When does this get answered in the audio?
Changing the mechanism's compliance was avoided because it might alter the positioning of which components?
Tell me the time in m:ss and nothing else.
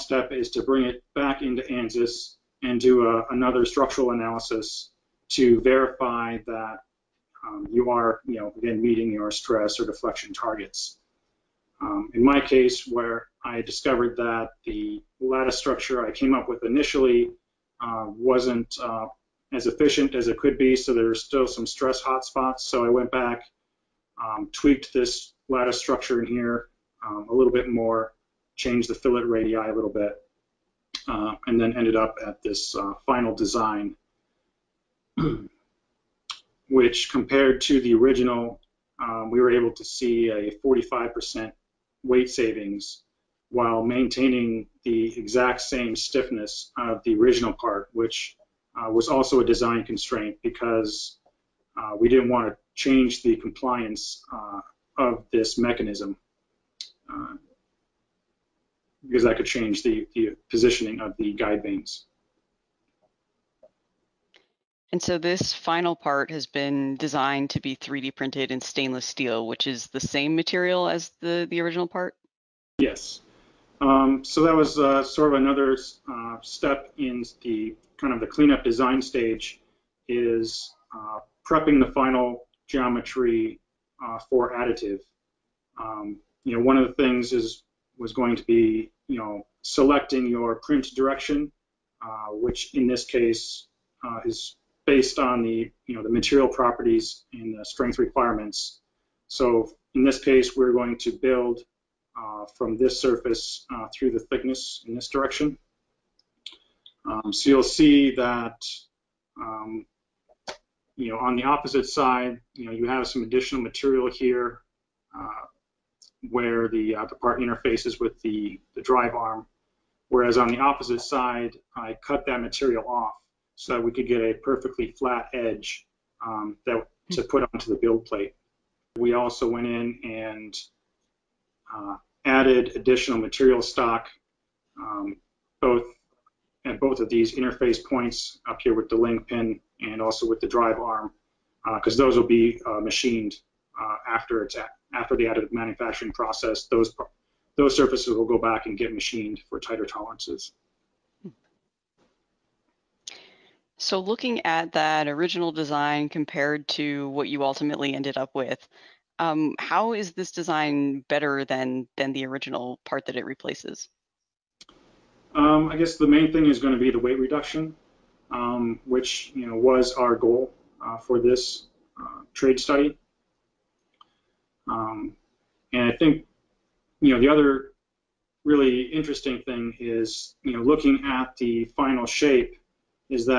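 1:01.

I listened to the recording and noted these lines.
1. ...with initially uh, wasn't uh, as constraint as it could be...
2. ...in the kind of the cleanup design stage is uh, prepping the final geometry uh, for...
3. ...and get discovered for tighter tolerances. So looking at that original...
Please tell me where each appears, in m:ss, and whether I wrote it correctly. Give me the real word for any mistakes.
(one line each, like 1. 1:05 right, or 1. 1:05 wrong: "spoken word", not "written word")
1. 0:16 wrong: "efficient", not "constraint"
2. 1:16 right
3. 2:28 wrong: "machined", not "discovered".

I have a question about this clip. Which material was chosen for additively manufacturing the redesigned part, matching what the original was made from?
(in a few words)
stainless steel.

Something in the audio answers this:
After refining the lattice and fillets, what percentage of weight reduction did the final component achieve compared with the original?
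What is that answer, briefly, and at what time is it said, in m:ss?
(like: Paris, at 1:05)
45%, at 0:40.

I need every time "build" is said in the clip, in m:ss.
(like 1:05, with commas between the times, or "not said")
1:41, 2:07.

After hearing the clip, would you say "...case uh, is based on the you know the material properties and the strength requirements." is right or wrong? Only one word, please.
right.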